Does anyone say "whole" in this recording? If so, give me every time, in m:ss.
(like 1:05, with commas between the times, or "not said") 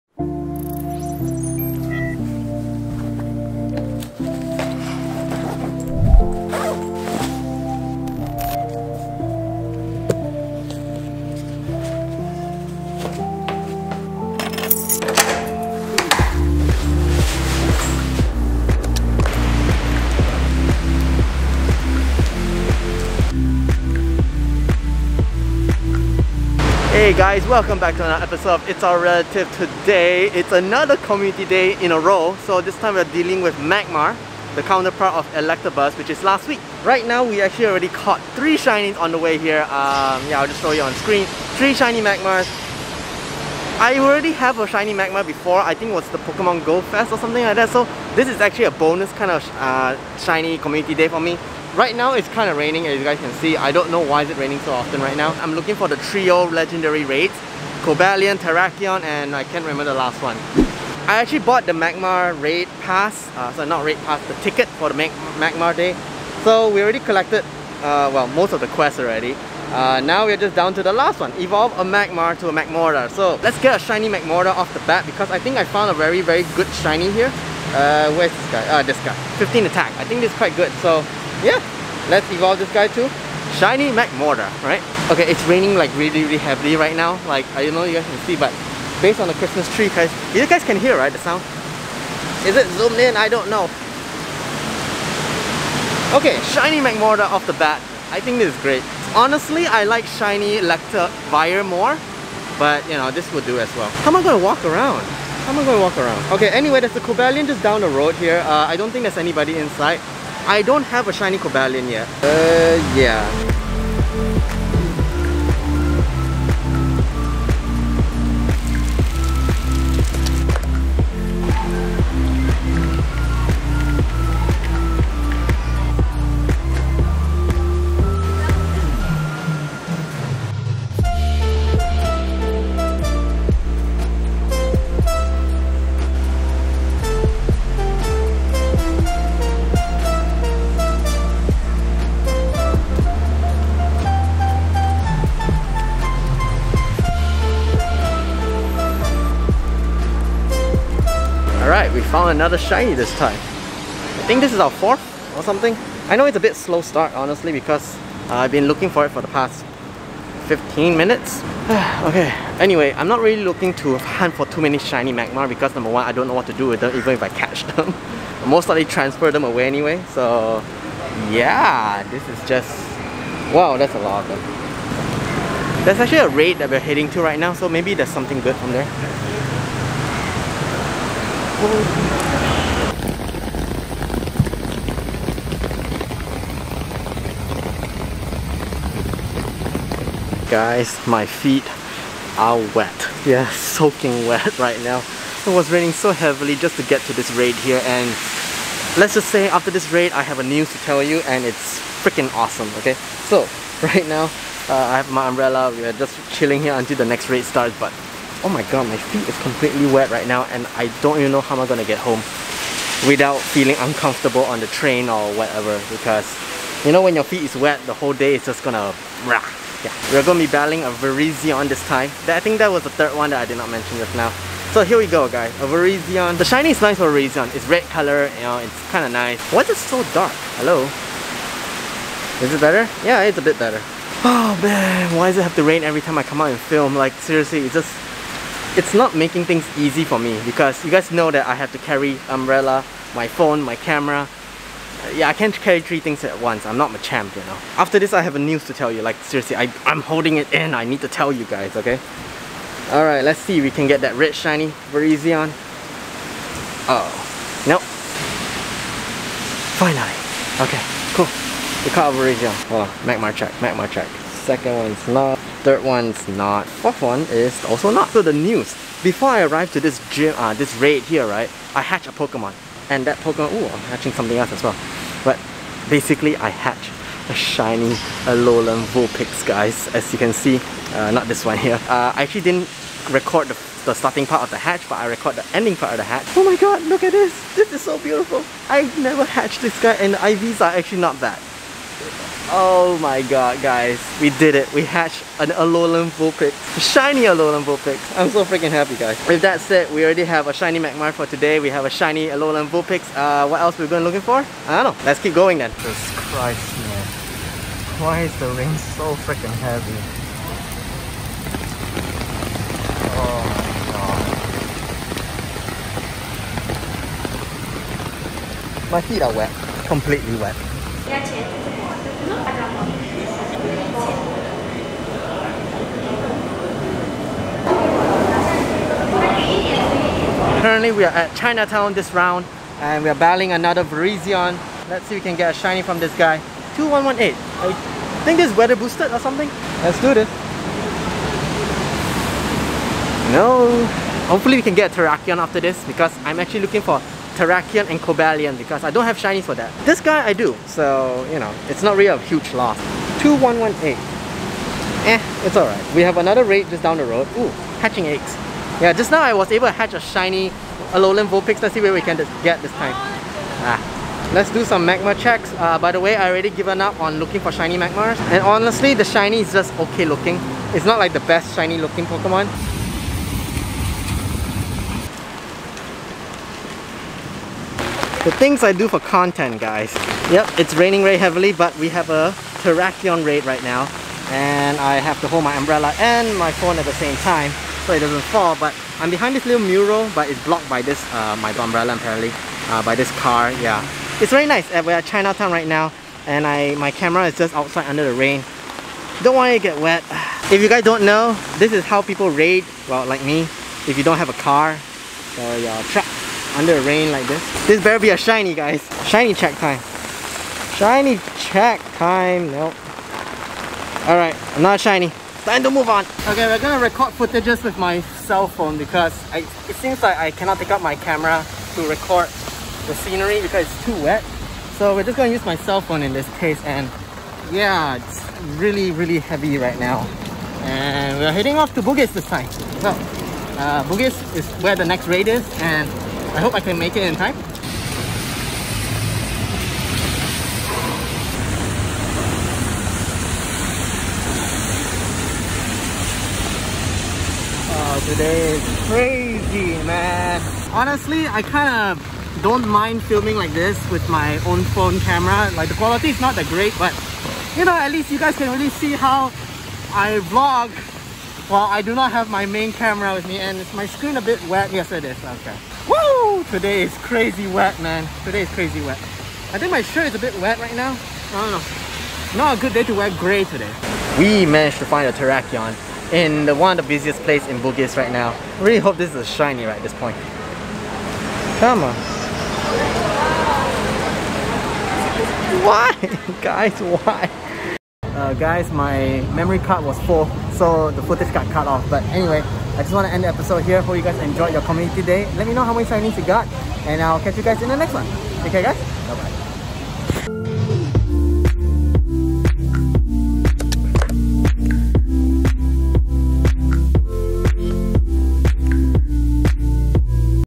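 3:37.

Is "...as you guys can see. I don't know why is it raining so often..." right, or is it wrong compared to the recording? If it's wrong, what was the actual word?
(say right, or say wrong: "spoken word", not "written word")
right.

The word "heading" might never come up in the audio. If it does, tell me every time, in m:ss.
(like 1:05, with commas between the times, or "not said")
2:56, 7:11.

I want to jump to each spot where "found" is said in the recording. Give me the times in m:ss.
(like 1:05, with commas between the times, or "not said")
1:15, 2:32.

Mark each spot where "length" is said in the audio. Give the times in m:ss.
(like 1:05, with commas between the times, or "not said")
not said.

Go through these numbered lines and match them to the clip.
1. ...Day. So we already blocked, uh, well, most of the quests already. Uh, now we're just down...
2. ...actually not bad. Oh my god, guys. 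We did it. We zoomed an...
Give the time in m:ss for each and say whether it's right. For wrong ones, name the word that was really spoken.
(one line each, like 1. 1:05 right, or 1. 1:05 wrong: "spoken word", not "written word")
1. 1:05 wrong: "collected", not "blocked"
2. 4:50 wrong: "hatched", not "zoomed".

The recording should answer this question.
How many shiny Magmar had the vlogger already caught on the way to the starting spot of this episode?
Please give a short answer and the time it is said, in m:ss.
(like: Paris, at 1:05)
3, at 0:38.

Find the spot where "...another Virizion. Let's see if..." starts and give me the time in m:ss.
5:33.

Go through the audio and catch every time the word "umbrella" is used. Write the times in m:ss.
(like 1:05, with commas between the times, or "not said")
3:25, 4:02, 6:25, 6:31.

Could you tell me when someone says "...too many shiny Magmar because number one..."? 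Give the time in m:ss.
2:44.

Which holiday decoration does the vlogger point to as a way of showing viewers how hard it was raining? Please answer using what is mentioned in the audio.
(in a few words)
Christmas tree.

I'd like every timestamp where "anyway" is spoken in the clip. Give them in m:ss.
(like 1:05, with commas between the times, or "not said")
1:46, 2:42, 2:49, 8:12.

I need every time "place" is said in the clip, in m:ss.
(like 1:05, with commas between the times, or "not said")
7:57.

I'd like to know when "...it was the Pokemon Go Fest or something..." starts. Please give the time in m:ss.
0:45.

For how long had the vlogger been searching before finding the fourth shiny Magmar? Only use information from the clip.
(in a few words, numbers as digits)
15 minutes.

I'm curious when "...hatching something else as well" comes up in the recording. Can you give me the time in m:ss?
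4:33.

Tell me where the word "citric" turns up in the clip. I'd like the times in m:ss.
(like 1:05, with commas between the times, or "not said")
not said.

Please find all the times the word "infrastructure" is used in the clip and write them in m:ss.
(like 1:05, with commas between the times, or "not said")
not said.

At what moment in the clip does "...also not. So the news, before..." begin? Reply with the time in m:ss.
4:27.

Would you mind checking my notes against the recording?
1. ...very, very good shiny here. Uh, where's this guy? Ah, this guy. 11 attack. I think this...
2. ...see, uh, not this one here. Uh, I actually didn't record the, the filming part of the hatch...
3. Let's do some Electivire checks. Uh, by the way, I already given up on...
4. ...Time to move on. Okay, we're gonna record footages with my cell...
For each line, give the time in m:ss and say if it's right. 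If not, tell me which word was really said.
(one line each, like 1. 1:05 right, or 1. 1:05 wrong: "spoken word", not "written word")
1. 1:15 wrong: "15", not "11"
2. 4:40 wrong: "starting", not "filming"
3. 6:04 wrong: "Magmar", not "Electivire"
4. 6:55 right.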